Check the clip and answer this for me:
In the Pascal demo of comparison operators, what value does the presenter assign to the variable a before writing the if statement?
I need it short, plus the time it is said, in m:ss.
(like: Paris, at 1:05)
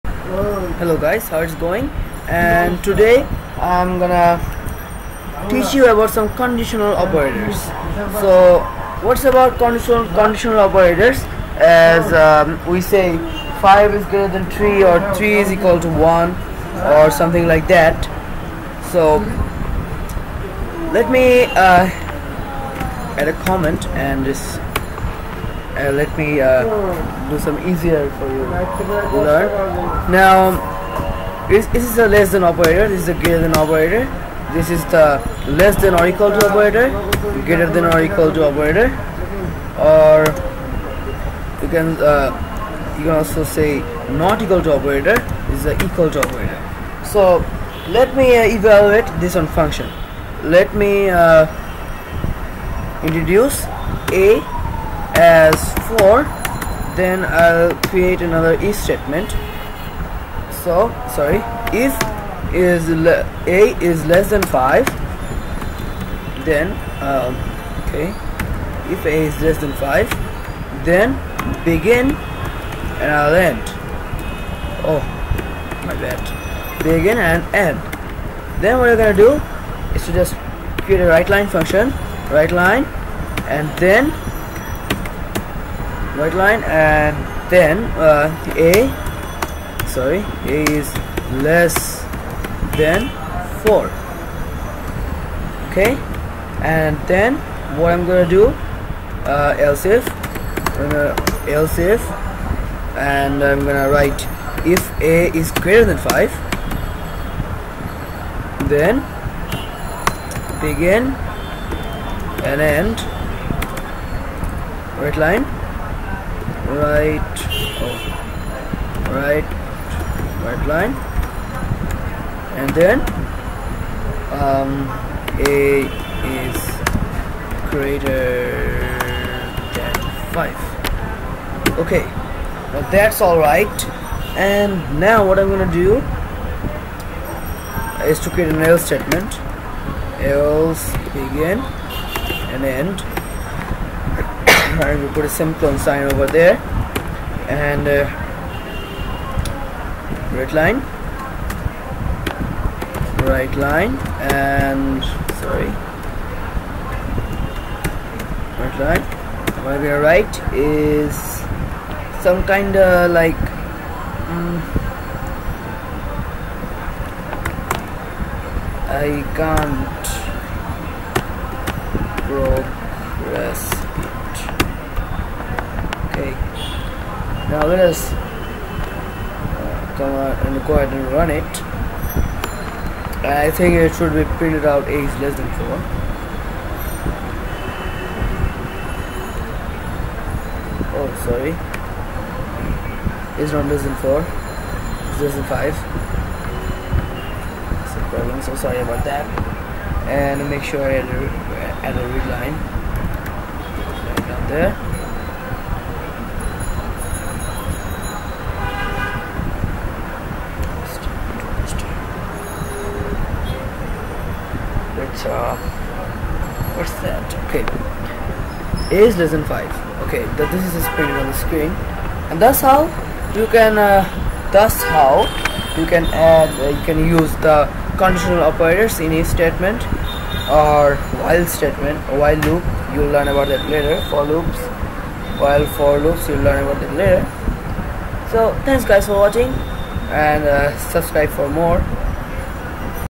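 4, at 0:53.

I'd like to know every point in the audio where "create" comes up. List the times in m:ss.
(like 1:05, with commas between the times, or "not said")
0:57, 1:20, 2:18.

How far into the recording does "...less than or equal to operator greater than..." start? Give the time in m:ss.
0:35.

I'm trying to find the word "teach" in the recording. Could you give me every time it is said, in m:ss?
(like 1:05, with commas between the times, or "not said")
0:05.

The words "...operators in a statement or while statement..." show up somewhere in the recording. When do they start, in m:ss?
3:48.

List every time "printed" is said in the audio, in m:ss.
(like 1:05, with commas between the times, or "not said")
3:04, 3:40.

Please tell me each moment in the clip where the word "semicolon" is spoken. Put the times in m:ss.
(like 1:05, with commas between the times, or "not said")
2:25.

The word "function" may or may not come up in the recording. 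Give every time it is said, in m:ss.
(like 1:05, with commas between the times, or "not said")
0:49, 1:21.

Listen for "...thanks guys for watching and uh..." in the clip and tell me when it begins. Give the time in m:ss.
3:58.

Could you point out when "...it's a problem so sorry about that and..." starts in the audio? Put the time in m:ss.
3:17.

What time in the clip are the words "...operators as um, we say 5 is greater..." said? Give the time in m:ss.
0:10.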